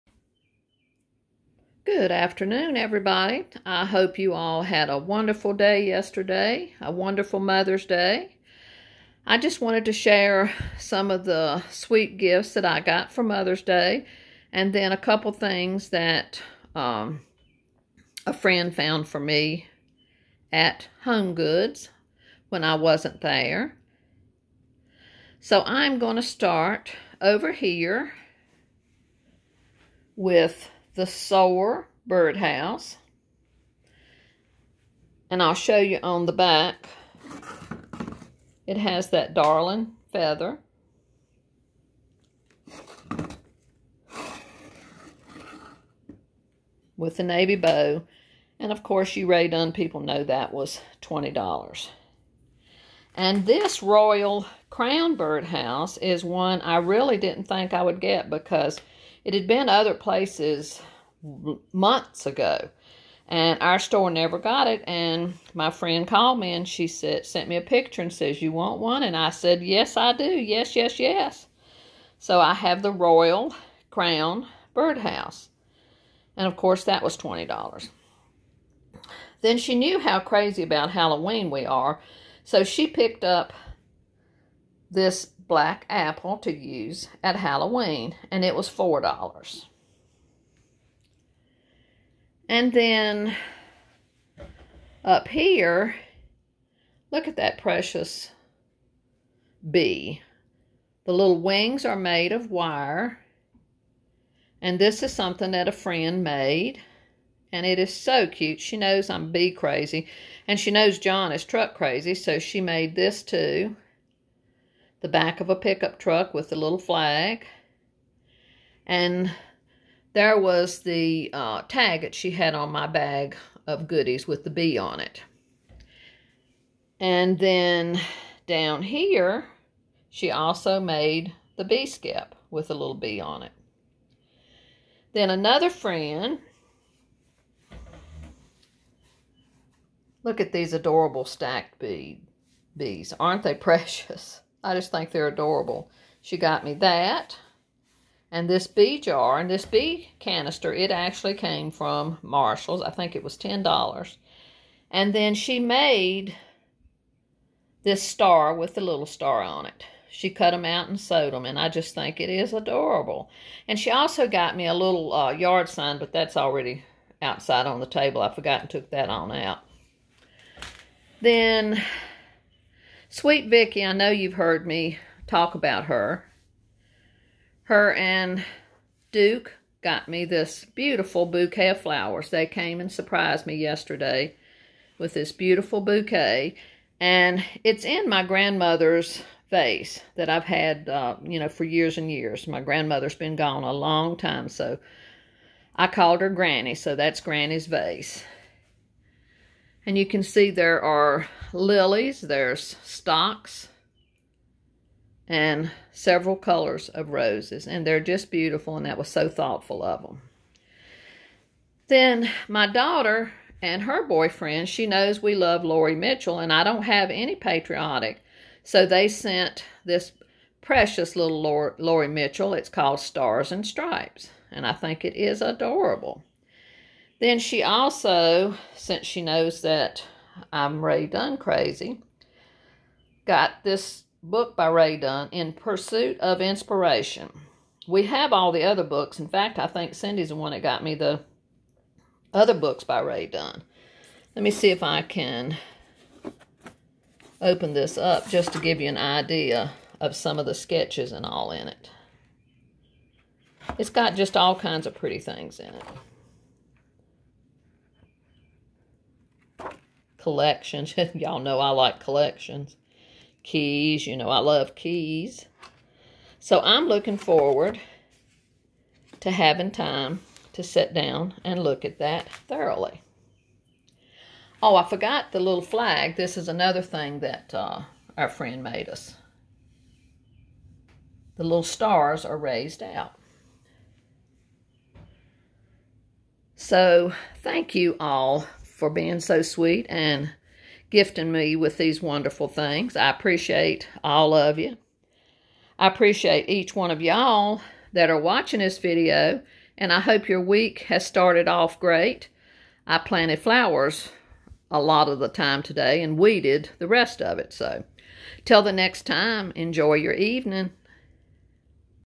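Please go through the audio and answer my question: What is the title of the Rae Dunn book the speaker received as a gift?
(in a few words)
In Pursuit of Inspiration.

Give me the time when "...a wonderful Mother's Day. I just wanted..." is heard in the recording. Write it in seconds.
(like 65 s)
6 s.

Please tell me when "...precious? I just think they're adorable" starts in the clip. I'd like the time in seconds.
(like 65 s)
143 s.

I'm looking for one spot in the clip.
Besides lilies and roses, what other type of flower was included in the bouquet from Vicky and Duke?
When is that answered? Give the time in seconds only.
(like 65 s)
202 s.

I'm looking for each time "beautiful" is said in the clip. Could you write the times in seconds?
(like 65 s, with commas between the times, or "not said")
180 s, 185 s, 208 s.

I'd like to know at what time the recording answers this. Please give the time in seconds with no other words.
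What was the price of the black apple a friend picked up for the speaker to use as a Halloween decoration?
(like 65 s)
88 s.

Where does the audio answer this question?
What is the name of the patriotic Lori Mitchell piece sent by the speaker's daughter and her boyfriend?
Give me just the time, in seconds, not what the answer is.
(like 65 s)
222 s.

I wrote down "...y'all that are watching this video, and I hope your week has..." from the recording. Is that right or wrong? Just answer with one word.
right.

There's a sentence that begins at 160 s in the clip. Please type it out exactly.
She cut them out and sewed them, and I just think it is adorable.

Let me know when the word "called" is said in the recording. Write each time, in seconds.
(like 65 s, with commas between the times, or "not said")
66 s, 195 s, 222 s.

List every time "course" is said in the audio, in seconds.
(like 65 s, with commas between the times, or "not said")
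48 s, 76 s.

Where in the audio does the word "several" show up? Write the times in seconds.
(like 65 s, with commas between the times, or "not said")
205 s.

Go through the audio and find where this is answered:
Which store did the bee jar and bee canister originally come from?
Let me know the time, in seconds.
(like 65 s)
152 s.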